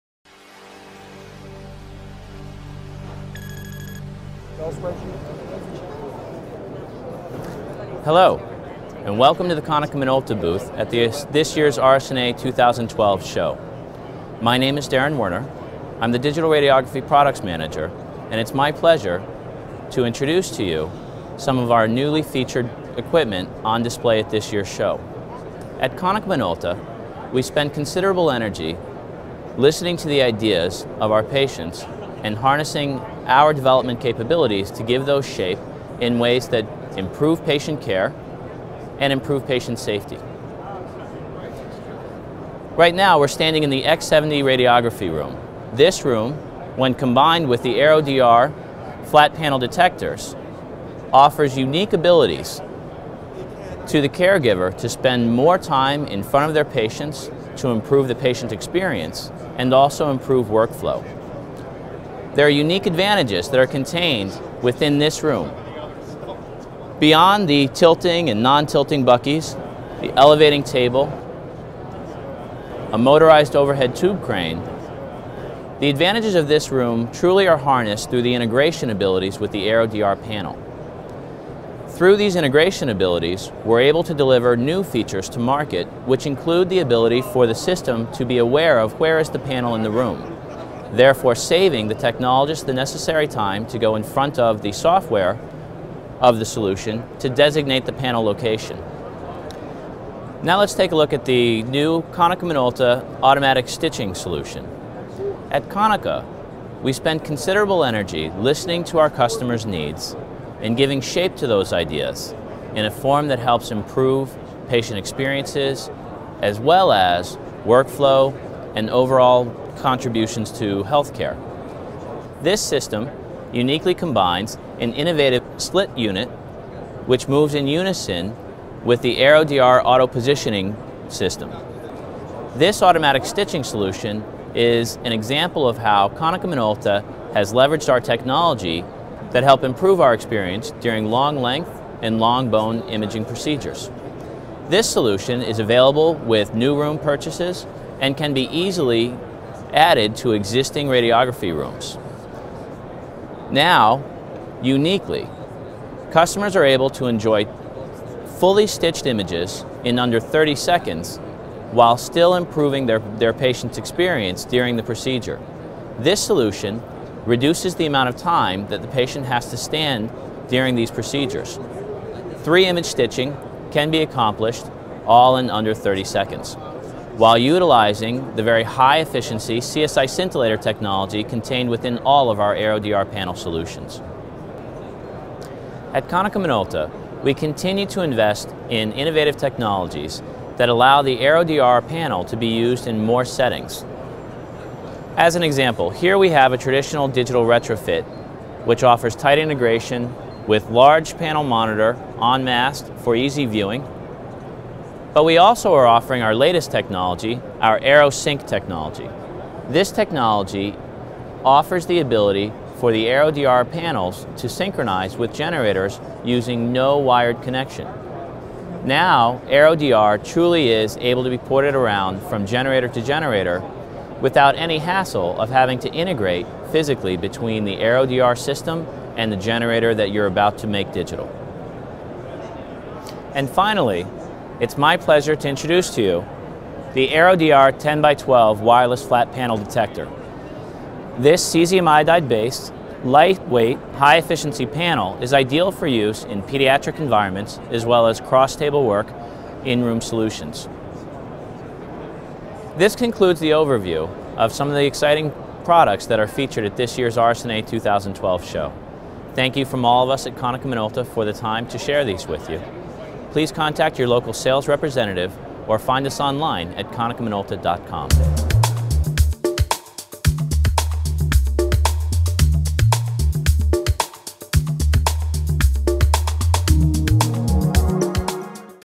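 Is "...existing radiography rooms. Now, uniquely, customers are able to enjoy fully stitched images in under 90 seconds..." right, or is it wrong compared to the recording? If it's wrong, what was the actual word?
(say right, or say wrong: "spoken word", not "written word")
wrong: "30", not "90".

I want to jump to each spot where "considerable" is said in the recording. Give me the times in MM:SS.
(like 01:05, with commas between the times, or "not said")
00:27, 01:47.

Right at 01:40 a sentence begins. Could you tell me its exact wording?
Now let's take a look at the new Konica Minolta automatic stitching solution.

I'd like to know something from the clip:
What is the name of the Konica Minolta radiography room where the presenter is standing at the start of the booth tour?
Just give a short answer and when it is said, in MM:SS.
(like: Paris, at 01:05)
X70, at 00:43.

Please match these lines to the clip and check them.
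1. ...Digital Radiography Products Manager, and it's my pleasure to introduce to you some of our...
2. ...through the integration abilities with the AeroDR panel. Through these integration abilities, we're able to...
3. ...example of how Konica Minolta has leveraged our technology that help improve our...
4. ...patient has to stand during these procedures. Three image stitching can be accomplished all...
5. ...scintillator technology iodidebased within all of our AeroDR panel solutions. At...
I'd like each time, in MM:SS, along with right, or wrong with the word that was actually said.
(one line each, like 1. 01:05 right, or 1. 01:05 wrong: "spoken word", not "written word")
1. 00:16 right
2. 01:18 right
3. 02:15 right
4. 02:48 right
5. 03:00 wrong: "contained", not "iodidebased".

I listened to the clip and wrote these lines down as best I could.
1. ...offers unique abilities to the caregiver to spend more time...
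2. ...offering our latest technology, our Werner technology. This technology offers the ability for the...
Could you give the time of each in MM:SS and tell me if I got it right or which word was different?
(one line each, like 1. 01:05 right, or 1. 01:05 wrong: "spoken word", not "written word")
1. 00:51 right
2. 03:25 wrong: "AeroSync", not "Werner".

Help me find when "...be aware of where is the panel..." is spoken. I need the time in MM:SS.
01:28.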